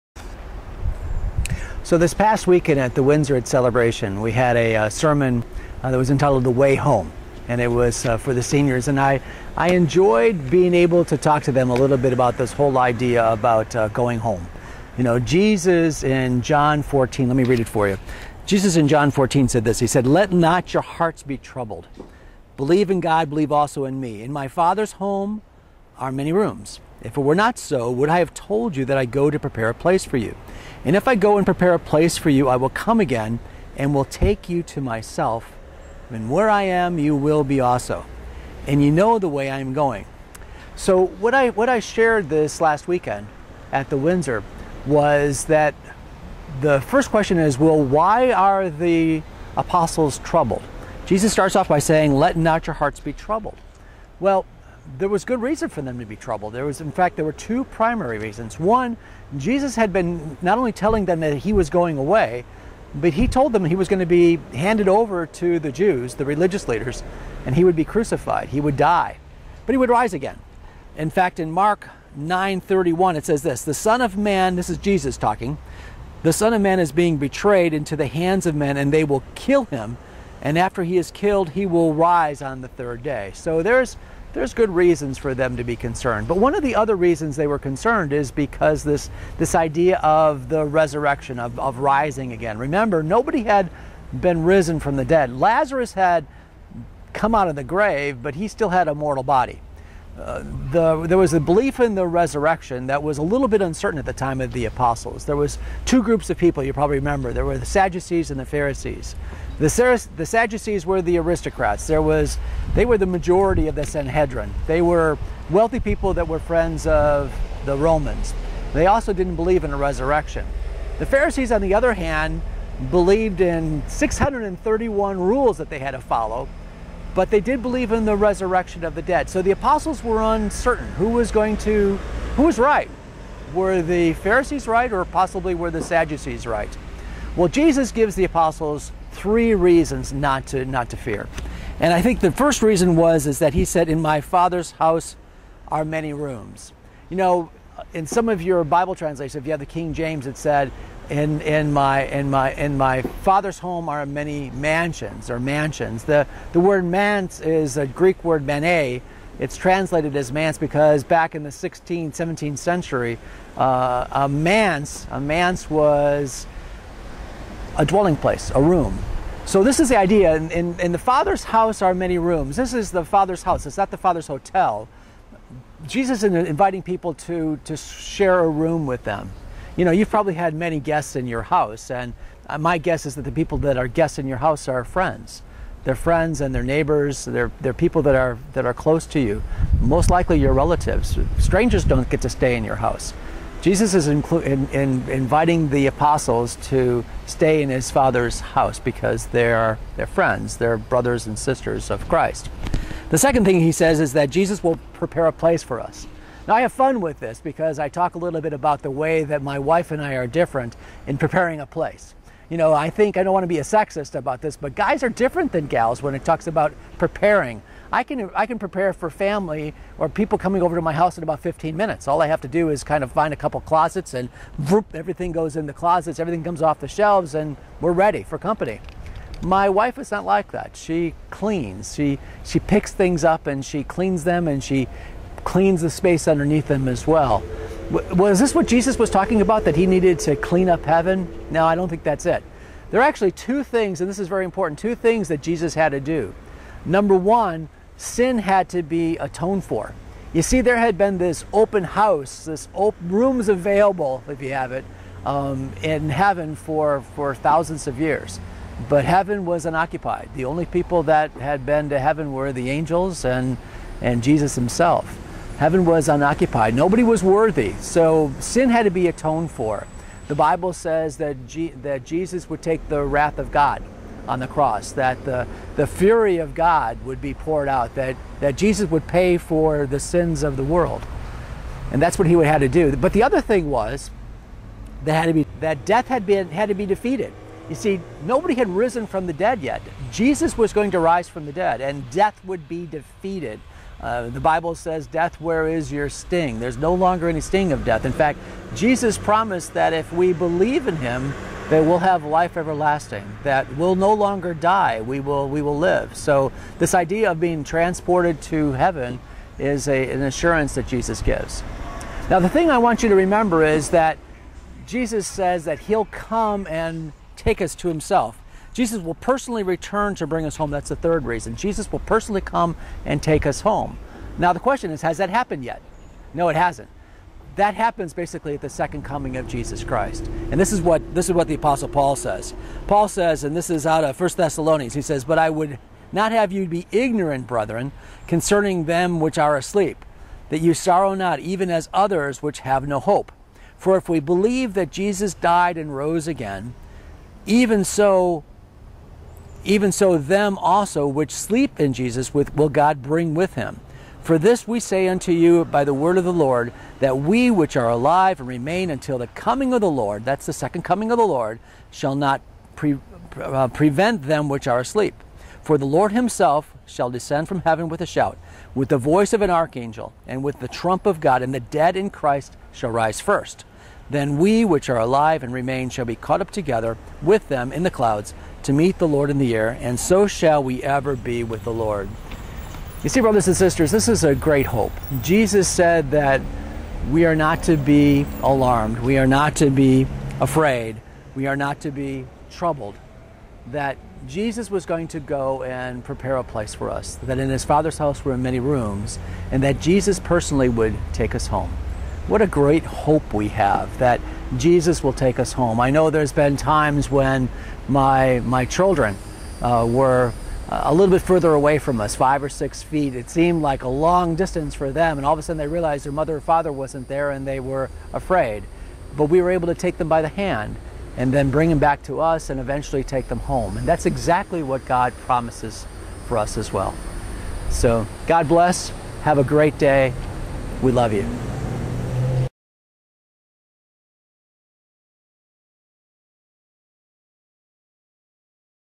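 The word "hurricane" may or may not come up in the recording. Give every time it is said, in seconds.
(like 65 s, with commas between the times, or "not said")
not said.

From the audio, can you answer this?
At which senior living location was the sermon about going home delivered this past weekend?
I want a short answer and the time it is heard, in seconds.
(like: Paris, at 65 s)
Windsor at Celebration, at 3 s.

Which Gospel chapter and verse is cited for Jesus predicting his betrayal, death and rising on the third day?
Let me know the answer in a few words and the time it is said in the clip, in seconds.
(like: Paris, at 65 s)
Mark 9:31, at 71 s.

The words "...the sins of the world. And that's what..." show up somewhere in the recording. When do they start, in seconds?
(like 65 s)
279 s.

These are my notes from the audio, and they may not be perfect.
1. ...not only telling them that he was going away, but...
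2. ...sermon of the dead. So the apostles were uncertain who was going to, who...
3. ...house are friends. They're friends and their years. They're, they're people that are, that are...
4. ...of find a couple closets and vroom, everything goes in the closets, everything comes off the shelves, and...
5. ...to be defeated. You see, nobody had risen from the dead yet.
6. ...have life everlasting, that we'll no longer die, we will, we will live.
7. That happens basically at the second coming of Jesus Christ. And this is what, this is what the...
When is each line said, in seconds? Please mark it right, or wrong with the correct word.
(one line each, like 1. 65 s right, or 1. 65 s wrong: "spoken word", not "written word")
1. 60 s right
2. 128 s wrong: "resurrection", not "sermon"
3. 184 s wrong: "neighbors", not "years"
4. 223 s right
5. 286 s right
6. 301 s right
7. 327 s right.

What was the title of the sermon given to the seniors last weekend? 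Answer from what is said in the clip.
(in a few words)
The Way Home.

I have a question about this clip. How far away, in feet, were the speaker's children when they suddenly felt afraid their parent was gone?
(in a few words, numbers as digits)
five or six feet.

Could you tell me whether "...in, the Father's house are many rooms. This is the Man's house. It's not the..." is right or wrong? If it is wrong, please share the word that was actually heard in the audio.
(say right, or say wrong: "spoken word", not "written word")
wrong: "Father", not "Man".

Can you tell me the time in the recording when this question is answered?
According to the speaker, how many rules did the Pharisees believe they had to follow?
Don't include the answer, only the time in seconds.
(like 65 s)
123 s.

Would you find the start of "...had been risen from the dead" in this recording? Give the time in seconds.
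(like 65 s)
93 s.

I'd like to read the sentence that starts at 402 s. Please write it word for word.
What a great hope we have that Jesus will take us home.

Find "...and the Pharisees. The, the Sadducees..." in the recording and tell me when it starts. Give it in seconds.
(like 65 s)
108 s.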